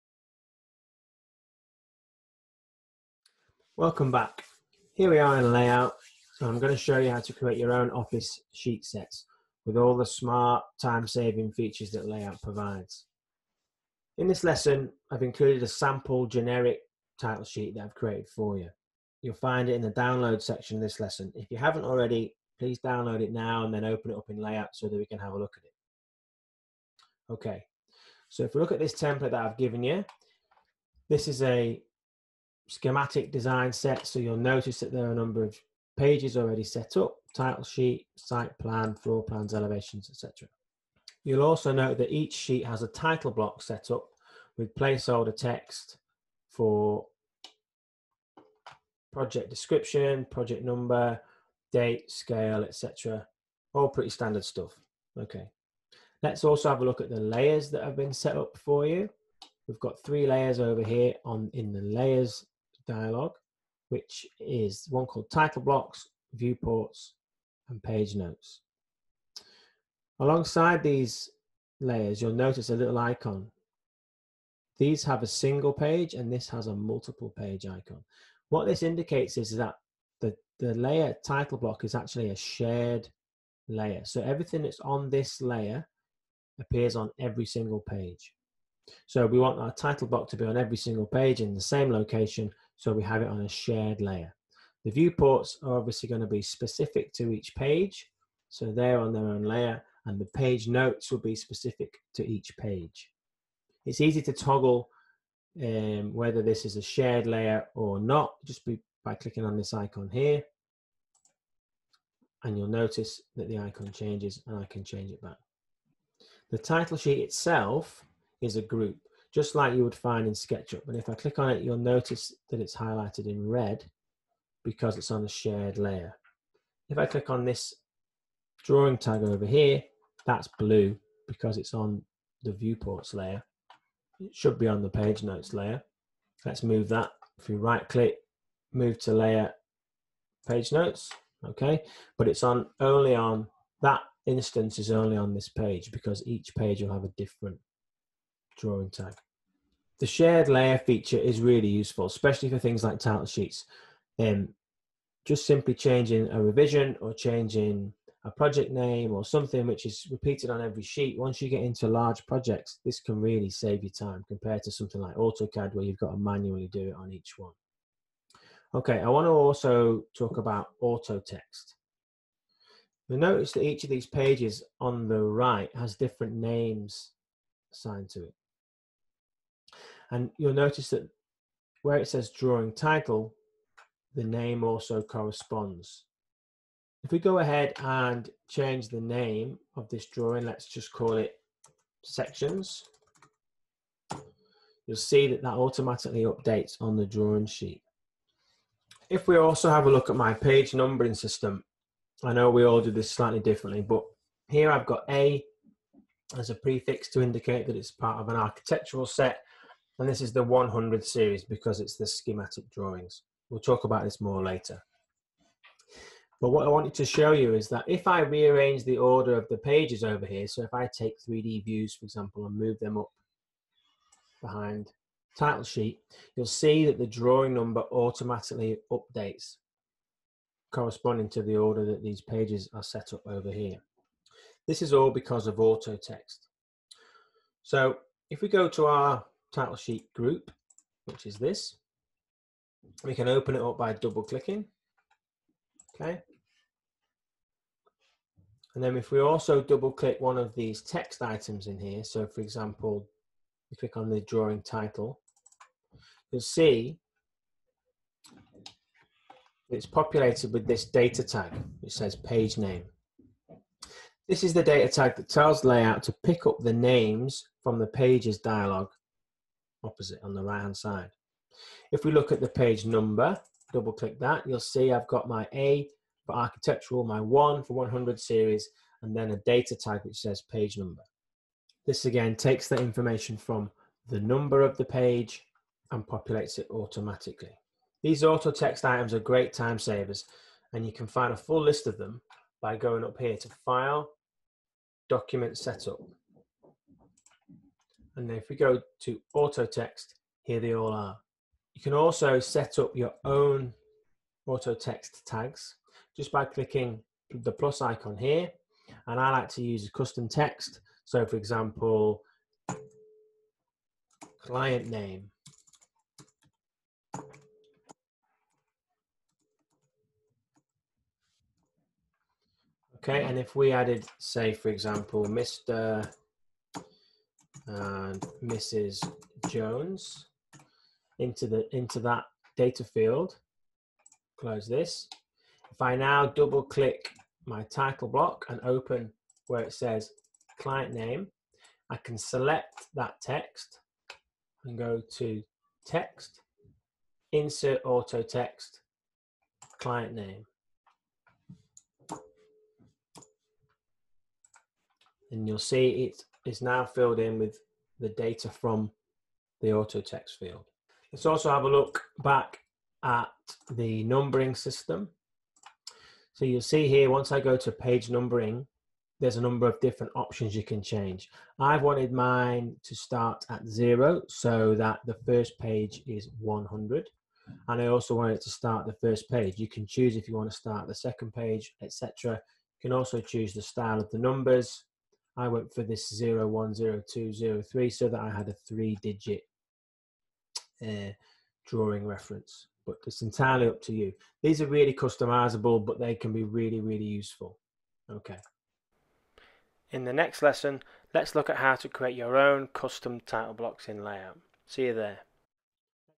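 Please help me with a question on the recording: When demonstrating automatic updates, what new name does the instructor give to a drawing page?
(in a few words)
sections.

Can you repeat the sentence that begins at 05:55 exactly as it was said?
And you'll see it's is now filled in with the data from the auto text field.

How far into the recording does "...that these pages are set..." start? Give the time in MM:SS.
03:51.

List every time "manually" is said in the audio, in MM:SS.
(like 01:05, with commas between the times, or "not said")
02:46.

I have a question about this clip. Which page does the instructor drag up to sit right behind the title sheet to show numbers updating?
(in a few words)
3D views.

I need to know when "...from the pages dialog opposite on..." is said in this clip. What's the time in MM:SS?
04:27.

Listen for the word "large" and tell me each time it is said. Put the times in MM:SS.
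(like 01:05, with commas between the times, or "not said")
02:41.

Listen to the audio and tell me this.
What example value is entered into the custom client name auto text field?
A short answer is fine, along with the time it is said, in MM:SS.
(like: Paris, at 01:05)
Mr and Mrs. Jones, at 05:25.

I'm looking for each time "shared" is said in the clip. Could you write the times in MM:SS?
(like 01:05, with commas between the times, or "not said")
01:22, 01:33, 01:46, 02:05, 02:30.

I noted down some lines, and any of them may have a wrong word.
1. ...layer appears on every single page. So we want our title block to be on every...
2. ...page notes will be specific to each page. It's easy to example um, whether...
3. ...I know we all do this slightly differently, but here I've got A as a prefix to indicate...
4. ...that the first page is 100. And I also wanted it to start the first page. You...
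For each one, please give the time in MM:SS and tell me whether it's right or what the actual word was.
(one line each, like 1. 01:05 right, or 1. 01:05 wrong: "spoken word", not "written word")
1. 01:25 right
2. 01:40 wrong: "toggle", not "example"
3. 03:22 right
4. 06:14 right.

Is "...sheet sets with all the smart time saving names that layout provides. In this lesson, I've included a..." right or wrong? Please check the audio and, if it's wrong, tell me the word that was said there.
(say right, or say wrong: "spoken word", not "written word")
wrong: "features", not "names".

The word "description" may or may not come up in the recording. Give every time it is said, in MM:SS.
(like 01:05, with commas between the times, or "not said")
00:49.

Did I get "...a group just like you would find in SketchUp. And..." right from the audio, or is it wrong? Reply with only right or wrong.
right.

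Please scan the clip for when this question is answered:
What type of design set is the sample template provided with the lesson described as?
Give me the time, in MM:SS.
00:32.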